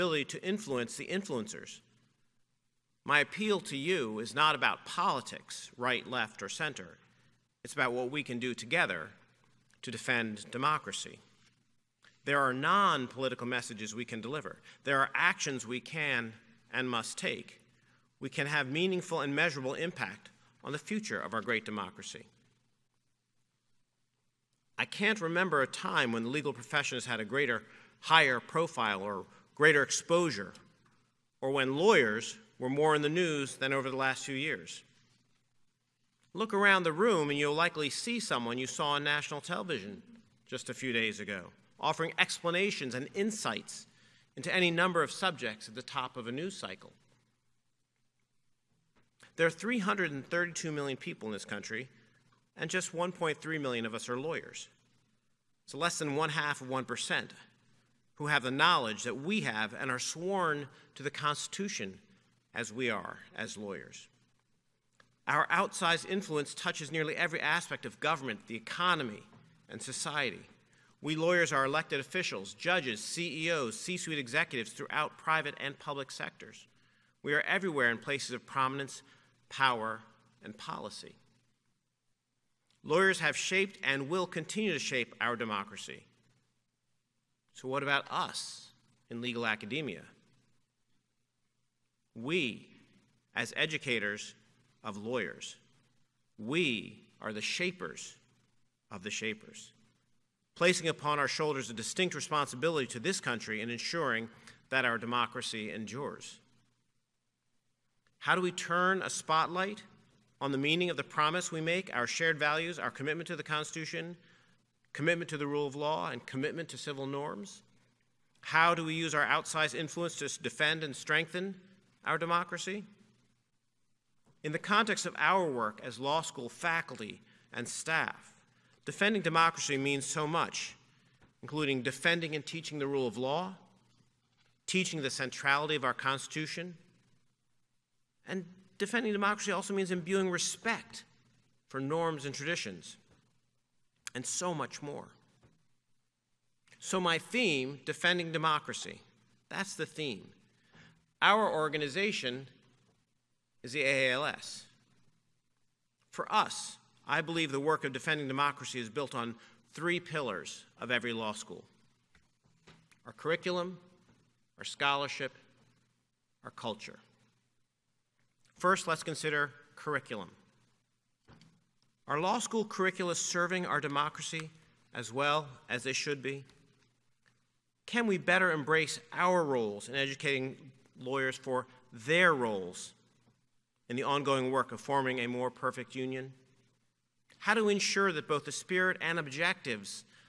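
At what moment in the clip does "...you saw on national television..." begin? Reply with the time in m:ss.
0:38.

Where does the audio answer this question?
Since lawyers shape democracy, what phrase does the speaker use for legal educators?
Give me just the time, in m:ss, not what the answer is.
1:37.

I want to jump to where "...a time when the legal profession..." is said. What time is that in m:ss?
0:25.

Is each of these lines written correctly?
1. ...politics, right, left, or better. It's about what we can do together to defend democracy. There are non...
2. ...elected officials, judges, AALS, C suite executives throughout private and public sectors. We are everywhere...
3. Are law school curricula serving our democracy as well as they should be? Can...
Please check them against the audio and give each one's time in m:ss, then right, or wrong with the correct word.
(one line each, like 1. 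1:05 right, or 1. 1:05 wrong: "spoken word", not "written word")
1. 0:04 wrong: "center", not "better"
2. 1:11 wrong: "CEOs", not "AALS"
3. 2:52 right.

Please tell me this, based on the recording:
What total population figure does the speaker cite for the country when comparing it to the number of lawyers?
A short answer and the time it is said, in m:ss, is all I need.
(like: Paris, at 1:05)
332 million, at 0:49.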